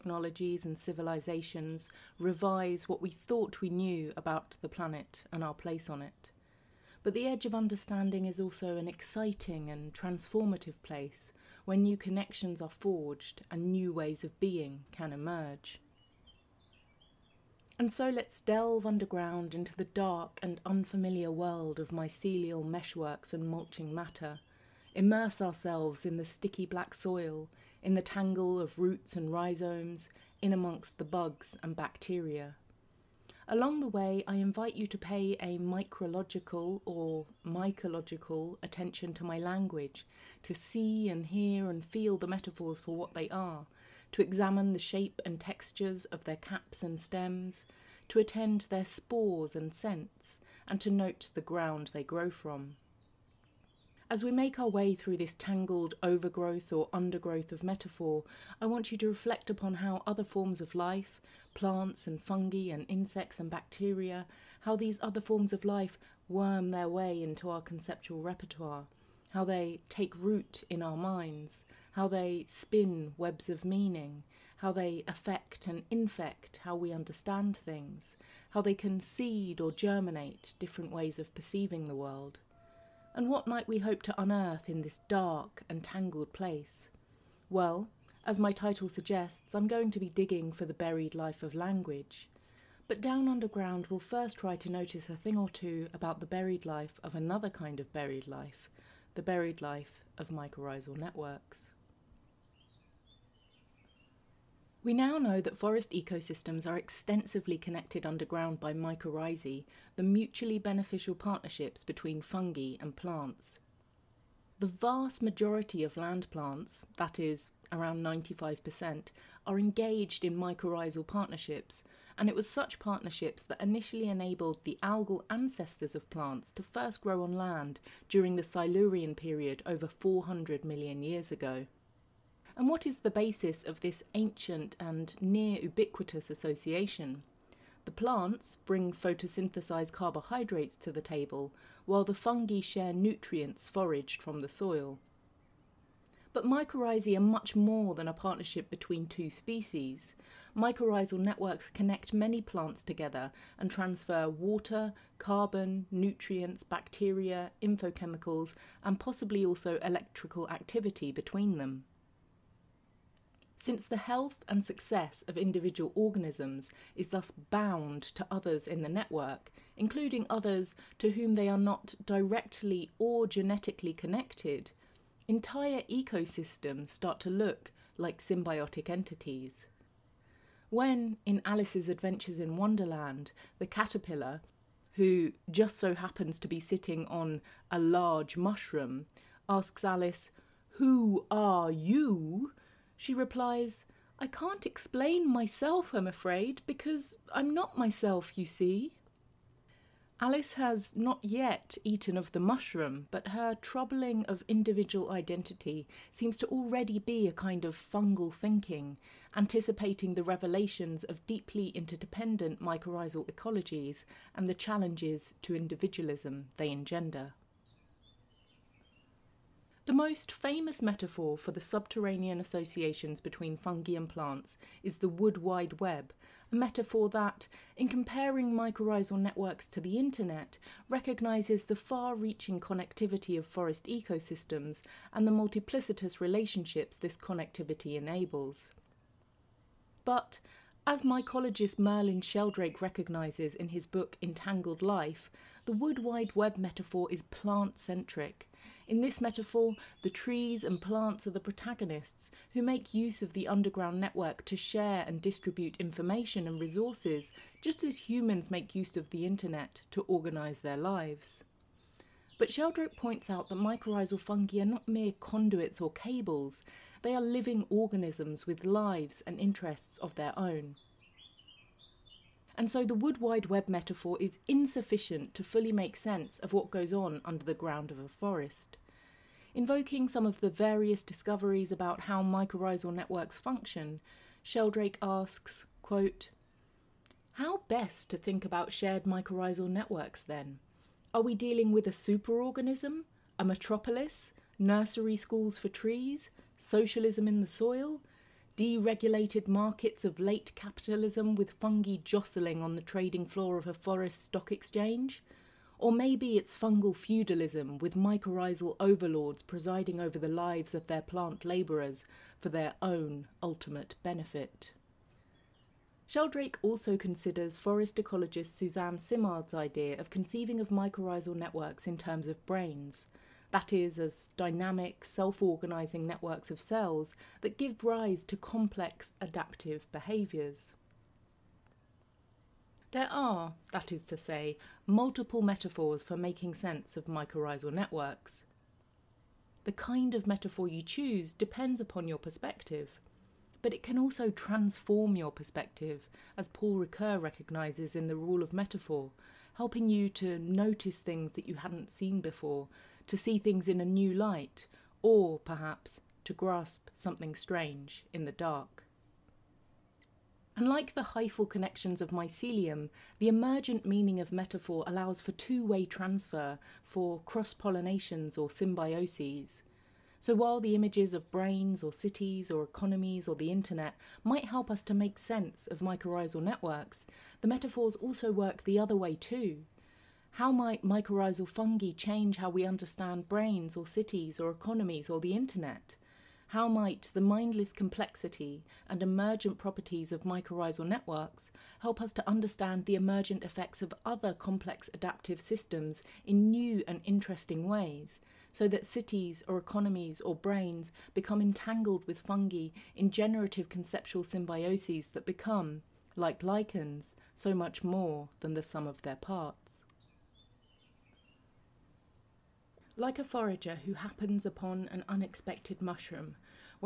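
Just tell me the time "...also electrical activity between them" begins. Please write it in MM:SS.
02:39.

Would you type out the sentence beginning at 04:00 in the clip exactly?
But, as mycologist Merlin Sheldrake recognizes in his book Entangled Life, the Wood Wide Web metaphor is plant centric.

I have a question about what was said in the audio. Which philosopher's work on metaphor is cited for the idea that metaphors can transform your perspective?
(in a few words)
Paul Ricoeur.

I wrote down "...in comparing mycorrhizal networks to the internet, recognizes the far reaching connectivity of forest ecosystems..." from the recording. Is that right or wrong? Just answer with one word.
right.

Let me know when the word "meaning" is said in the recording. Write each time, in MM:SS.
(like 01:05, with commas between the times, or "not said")
01:13, 06:03.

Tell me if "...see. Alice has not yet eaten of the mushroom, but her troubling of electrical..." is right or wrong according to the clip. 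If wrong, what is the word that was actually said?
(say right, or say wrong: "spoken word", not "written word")
wrong: "individual", not "electrical".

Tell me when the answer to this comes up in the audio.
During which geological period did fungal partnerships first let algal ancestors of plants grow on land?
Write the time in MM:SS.
02:08.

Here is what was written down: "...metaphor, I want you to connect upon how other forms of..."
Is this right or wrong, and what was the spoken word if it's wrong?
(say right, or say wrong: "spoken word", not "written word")
wrong: "reflect", not "connect".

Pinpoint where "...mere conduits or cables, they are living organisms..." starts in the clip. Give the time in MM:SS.
04:24.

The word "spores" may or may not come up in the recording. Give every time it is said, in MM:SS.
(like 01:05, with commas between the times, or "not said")
00:48.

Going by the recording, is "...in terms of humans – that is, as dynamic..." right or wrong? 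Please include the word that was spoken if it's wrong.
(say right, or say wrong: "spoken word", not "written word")
wrong: "brains", not "humans".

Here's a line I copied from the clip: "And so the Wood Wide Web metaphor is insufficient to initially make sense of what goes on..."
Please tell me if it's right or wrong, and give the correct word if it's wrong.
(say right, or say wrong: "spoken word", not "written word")
wrong: "fully", not "initially".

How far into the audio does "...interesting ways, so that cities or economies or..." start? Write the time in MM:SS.
06:37.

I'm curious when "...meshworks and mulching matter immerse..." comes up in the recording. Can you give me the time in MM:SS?
00:22.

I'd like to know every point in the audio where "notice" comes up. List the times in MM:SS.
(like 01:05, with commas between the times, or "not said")
01:34, 05:50.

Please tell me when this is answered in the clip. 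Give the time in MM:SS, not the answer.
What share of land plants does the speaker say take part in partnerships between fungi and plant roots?
01:58.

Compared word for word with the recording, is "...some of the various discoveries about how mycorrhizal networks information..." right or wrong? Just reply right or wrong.
wrong.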